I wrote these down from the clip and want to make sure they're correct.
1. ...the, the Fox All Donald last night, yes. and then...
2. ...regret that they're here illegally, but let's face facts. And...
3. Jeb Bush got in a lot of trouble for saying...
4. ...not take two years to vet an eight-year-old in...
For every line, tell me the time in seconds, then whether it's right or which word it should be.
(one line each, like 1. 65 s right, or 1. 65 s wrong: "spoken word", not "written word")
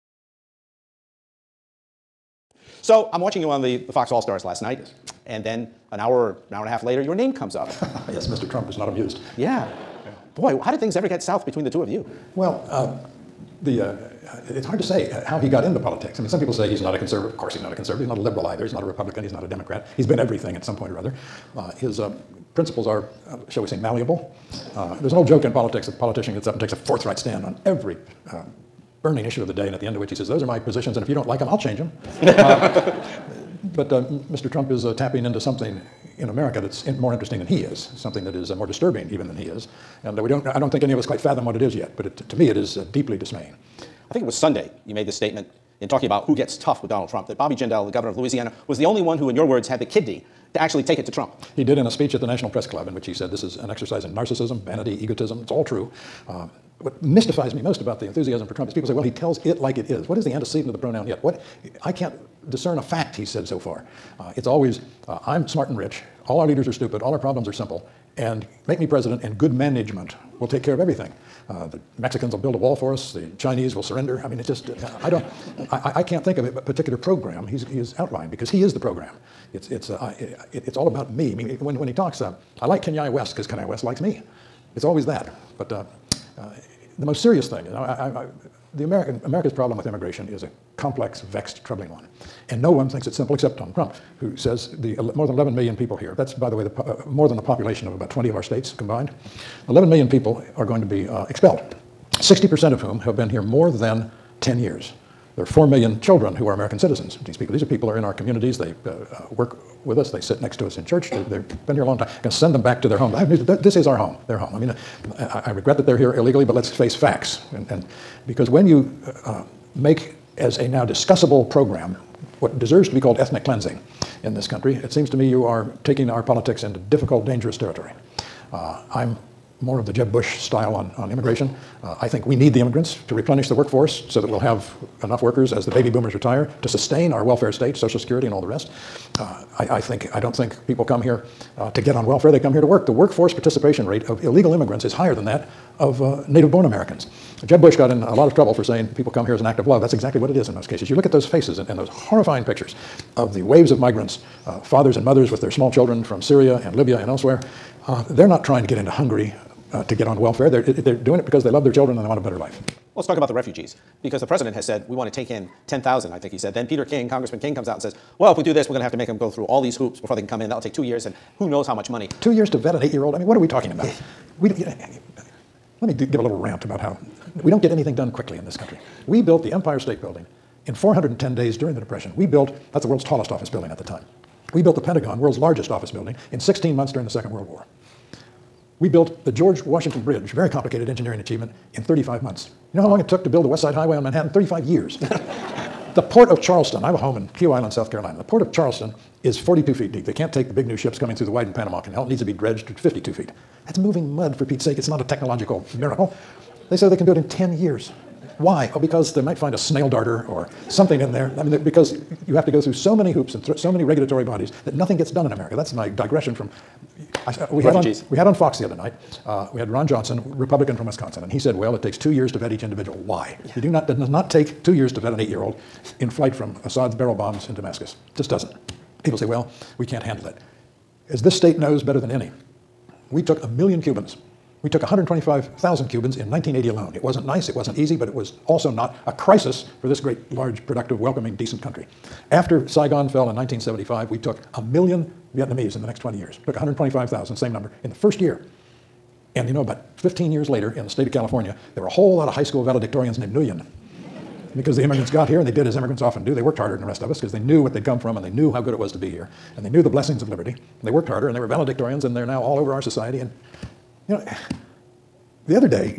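1. 3 s wrong: "Stars", not "Donald"
2. 115 s right
3. 147 s right
4. 224 s right.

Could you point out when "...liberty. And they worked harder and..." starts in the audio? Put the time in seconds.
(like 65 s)
260 s.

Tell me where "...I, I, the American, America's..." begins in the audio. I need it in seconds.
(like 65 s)
87 s.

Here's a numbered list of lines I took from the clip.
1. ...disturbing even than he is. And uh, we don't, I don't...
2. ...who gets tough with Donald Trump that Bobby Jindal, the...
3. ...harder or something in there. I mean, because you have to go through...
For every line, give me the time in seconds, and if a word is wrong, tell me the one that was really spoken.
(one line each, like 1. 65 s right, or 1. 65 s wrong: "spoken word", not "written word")
1. 38 s right
2. 46 s right
3. 209 s wrong: "darter", not "harder".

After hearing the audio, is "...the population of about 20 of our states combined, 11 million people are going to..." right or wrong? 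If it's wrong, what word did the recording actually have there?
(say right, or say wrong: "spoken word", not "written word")
right.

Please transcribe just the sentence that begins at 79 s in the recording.
It's, it's, uh, I, it, it's all about me.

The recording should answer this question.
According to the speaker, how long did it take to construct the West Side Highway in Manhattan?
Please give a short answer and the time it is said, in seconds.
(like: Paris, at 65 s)
35 years, at 194 s.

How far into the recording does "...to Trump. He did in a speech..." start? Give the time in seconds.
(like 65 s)
51 s.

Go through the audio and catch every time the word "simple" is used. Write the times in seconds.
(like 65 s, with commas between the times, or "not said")
67 s, 93 s.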